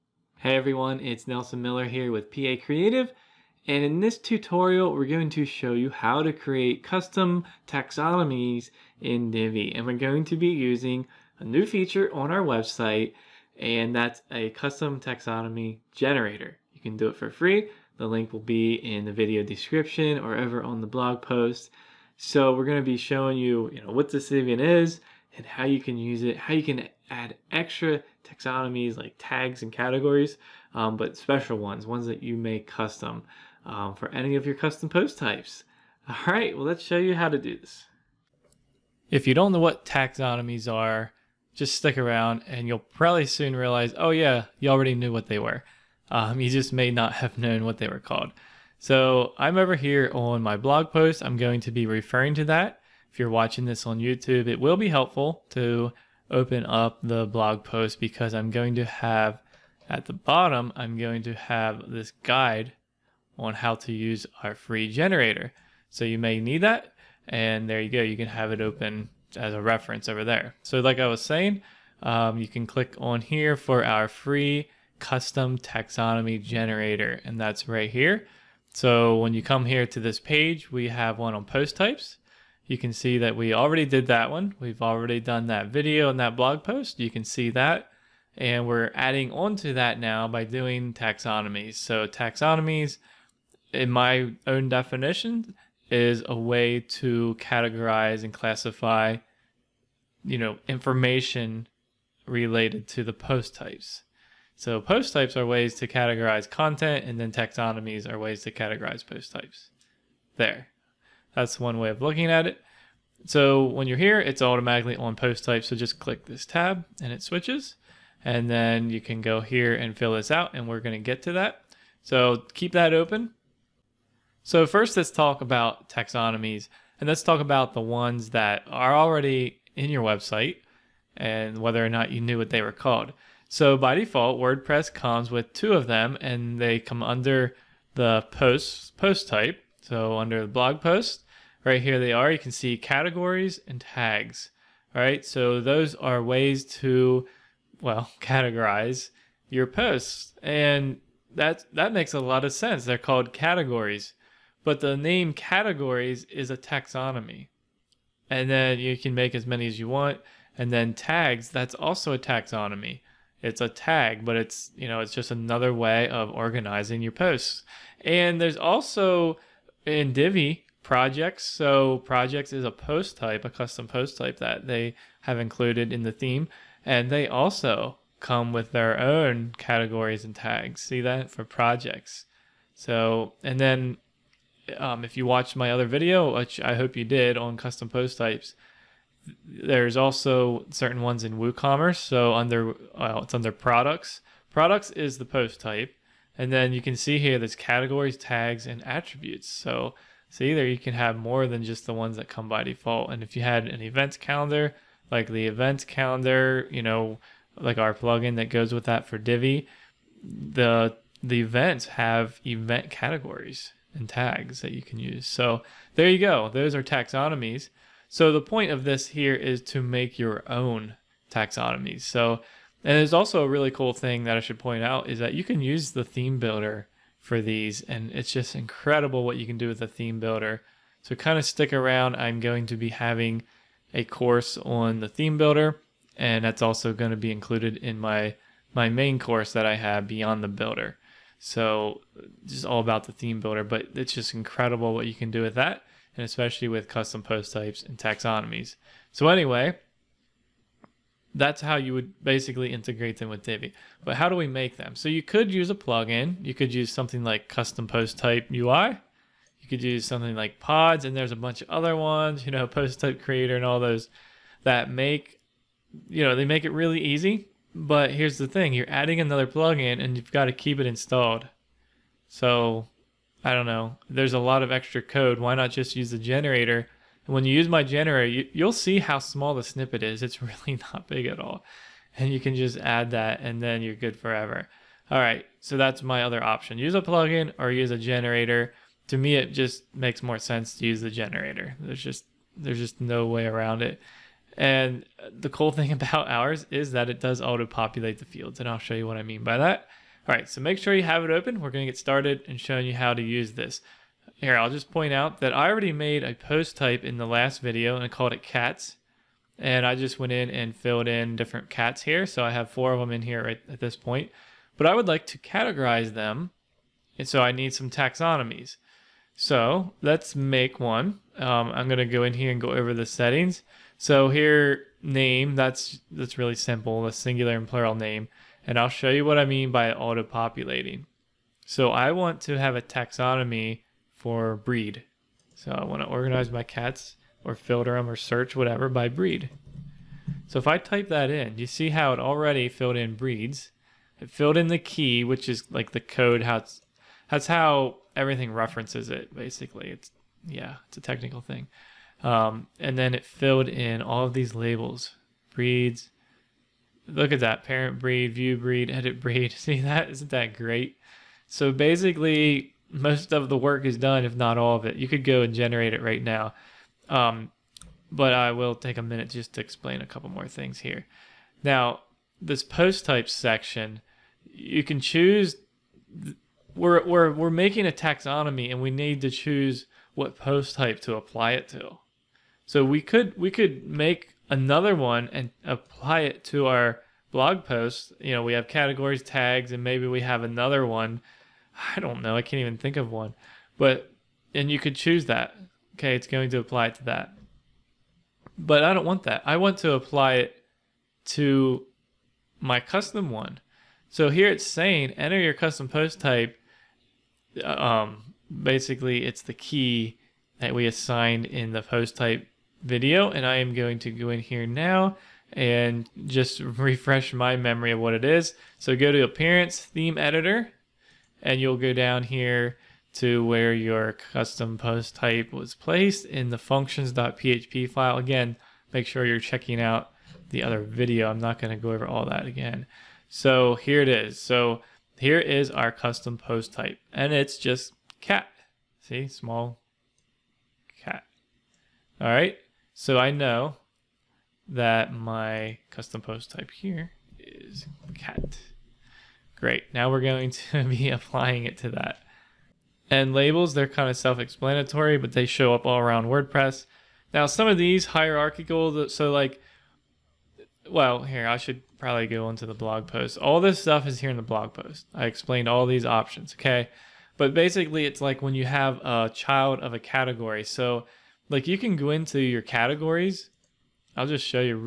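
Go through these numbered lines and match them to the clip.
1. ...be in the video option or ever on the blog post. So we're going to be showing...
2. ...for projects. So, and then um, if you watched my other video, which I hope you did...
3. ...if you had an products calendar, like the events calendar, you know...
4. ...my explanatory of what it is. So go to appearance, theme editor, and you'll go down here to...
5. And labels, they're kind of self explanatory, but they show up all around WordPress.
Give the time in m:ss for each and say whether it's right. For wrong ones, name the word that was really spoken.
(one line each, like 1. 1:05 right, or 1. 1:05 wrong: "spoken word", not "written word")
1. 0:18 wrong: "description", not "option"
2. 3:01 right
3. 3:23 wrong: "events", not "products"
4. 6:57 wrong: "memory", not "explanatory"
5. 7:33 right.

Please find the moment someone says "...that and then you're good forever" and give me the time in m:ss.
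4:43.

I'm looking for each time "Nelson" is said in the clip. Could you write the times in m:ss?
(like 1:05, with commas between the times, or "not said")
0:01.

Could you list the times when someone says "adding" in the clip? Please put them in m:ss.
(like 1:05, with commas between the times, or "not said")
1:28, 4:28.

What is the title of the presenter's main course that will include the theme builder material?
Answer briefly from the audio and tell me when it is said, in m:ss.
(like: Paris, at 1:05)
Beyond the Builder, at 4:00.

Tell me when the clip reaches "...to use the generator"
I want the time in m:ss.
4:50.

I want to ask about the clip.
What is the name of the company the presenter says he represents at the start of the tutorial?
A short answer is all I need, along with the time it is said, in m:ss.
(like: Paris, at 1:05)
Pee-Aye Creative, at 0:02.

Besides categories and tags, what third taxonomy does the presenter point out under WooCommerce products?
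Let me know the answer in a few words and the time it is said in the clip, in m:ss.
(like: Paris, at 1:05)
Attributes, at 3:18.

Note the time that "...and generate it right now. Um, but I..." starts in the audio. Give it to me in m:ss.
6:05.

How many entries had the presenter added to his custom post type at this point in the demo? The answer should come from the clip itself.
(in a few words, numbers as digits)
4.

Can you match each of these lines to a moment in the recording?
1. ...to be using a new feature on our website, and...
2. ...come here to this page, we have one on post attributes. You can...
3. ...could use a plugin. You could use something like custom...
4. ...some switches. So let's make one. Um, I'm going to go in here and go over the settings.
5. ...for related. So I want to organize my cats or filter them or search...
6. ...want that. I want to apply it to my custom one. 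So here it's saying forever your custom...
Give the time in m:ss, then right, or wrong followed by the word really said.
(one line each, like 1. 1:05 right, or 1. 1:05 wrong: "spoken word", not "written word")
1. 0:10 right
2. 1:19 wrong: "types", not "attributes"
3. 4:15 right
4. 5:17 wrong: "taxonomies", not "switches"
5. 5:34 wrong: "breed", not "related"
6. 6:39 wrong: "enter", not "forever".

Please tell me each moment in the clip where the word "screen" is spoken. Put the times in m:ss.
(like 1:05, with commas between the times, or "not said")
not said.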